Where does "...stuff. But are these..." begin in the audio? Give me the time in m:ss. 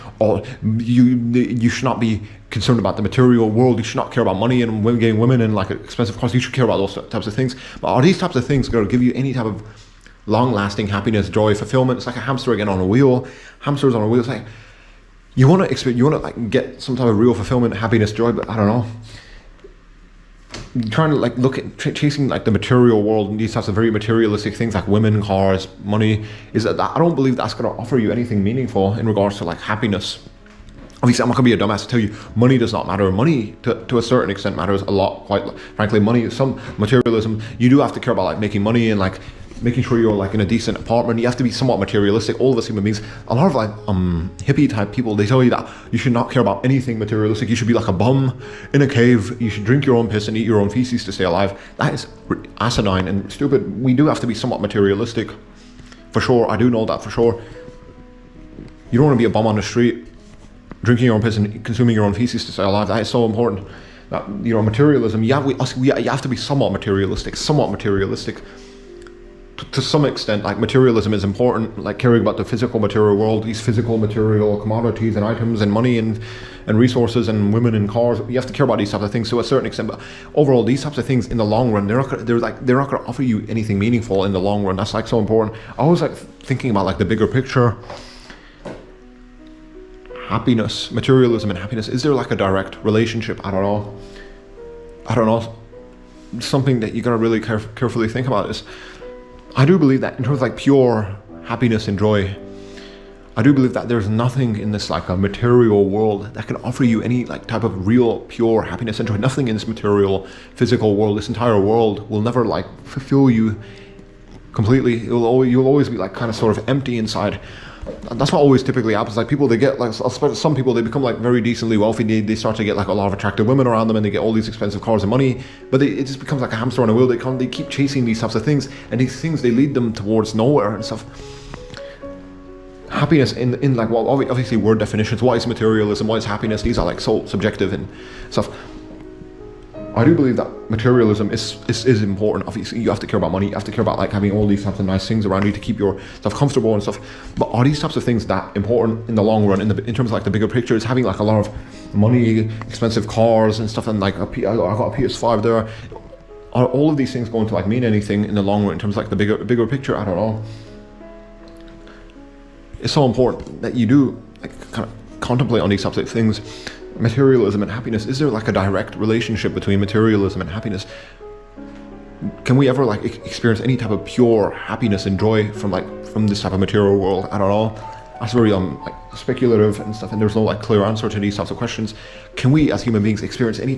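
2:26.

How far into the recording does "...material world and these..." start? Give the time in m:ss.
0:22.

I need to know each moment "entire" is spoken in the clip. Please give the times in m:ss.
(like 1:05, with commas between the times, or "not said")
1:51.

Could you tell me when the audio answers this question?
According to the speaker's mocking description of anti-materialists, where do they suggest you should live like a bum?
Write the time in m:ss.
0:48.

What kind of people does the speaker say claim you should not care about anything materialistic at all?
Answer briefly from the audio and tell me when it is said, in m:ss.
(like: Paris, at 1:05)
Hippie type people, at 0:44.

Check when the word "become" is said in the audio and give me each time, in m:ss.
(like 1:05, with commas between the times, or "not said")
2:00, 2:06.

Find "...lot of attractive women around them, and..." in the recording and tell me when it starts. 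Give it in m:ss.
2:02.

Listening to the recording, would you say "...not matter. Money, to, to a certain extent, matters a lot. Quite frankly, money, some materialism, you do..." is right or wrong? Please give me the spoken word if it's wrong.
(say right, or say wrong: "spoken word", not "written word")
right.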